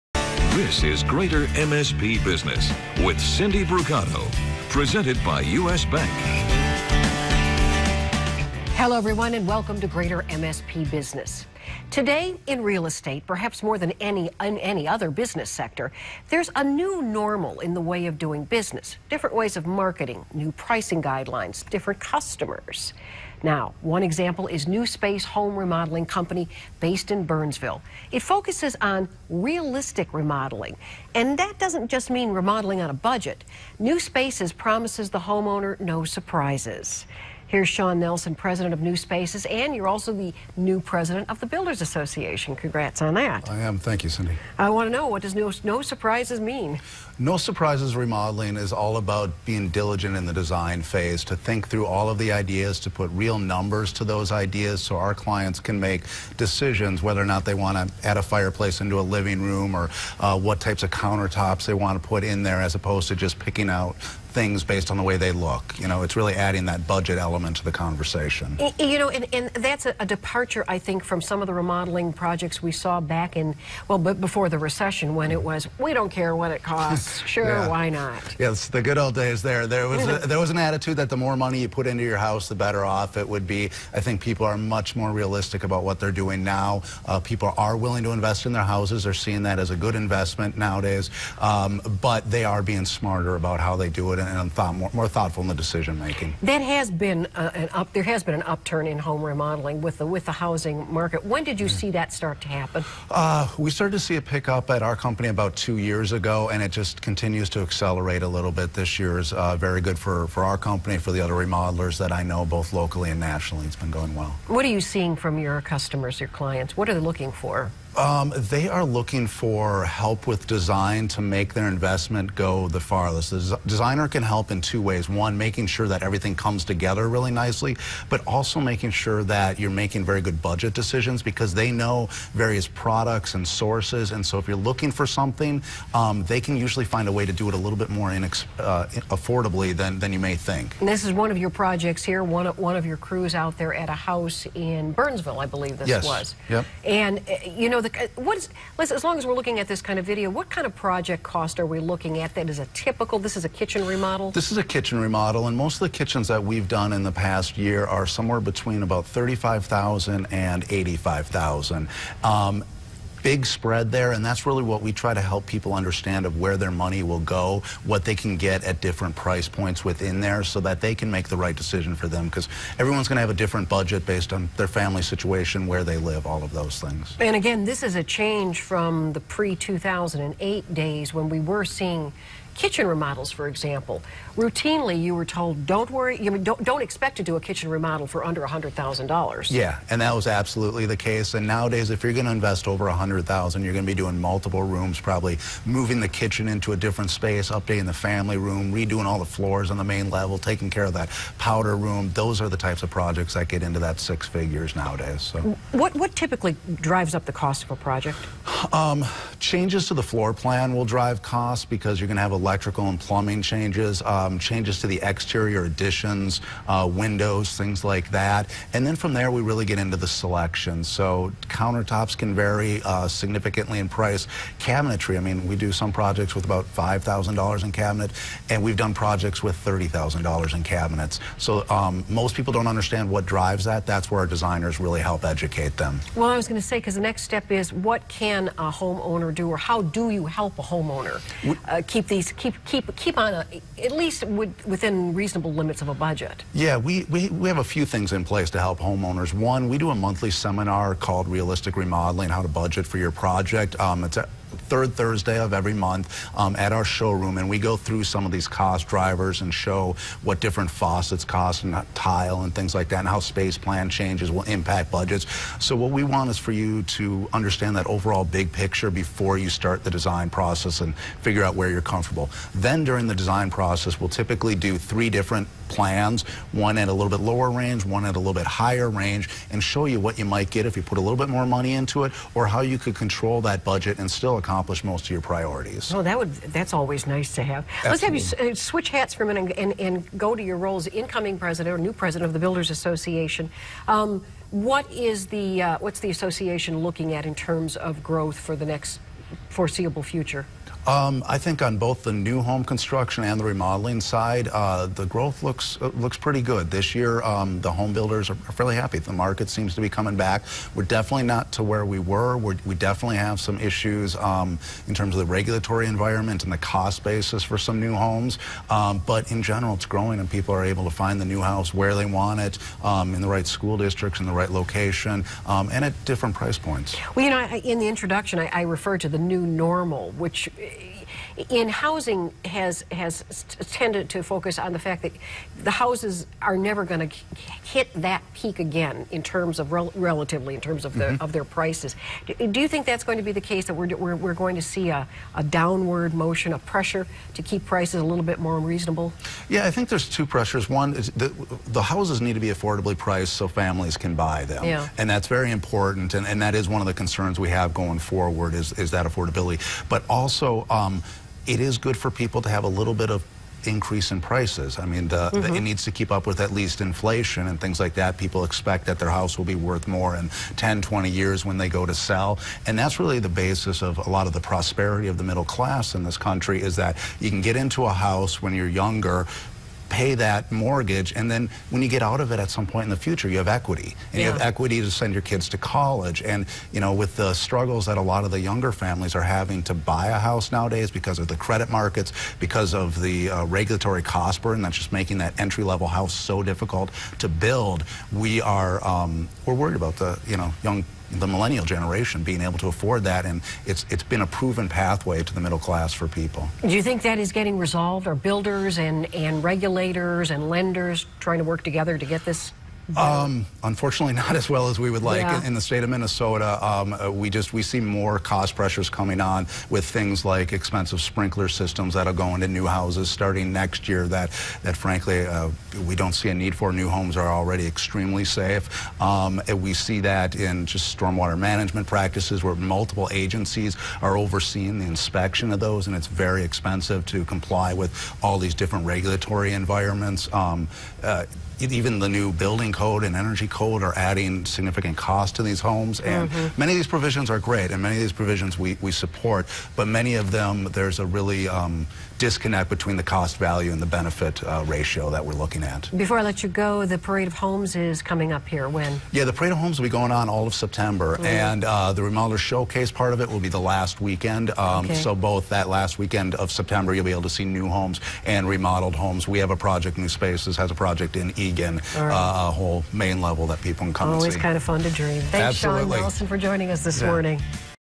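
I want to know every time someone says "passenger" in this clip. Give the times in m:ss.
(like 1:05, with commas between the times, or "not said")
not said.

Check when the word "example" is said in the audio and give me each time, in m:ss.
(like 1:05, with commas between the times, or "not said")
0:24, 3:03.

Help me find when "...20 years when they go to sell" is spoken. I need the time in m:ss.
6:10.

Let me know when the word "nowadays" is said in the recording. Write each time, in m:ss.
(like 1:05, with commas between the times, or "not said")
1:30, 3:11, 3:24, 6:30.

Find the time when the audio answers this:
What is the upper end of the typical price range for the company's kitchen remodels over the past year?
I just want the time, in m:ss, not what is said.
2:40.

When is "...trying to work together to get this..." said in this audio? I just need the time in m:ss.
6:51.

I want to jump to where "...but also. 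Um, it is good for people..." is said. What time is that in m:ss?
5:59.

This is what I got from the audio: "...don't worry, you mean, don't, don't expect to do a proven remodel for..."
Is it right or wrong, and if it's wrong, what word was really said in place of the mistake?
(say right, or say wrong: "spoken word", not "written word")
wrong: "kitchen", not "proven".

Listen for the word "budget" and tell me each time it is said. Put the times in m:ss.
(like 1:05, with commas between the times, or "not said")
0:32, 1:06, 2:10, 2:53, 4:05, 4:12, 4:24, 4:43.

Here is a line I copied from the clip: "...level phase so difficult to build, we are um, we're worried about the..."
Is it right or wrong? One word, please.
wrong.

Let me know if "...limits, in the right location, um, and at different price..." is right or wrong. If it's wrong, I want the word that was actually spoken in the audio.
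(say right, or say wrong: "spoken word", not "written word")
wrong: "districts", not "limits".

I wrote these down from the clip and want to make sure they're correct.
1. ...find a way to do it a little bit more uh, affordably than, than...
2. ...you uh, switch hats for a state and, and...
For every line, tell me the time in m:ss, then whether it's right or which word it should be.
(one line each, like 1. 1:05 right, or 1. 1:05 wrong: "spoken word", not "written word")
1. 2:16 right
2. 4:48 wrong: "minute", not "state".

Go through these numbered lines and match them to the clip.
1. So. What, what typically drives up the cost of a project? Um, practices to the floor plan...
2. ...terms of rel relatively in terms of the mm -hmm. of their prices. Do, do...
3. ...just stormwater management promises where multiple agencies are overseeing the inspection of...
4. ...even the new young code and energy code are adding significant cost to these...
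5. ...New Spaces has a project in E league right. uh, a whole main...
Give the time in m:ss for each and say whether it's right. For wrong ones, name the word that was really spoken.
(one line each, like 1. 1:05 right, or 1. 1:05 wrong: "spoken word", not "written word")
1. 3:25 wrong: "changes", not "practices"
2. 5:39 right
3. 7:10 wrong: "practices", not "promises"
4. 7:21 wrong: "building", not "young"
5. 7:49 right.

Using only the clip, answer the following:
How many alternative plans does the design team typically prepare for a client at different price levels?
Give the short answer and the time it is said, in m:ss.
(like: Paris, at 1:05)
3, at 4:34.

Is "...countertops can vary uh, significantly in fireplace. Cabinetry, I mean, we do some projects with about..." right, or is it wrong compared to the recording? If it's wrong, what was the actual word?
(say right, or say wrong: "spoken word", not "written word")
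wrong: "price", not "fireplace".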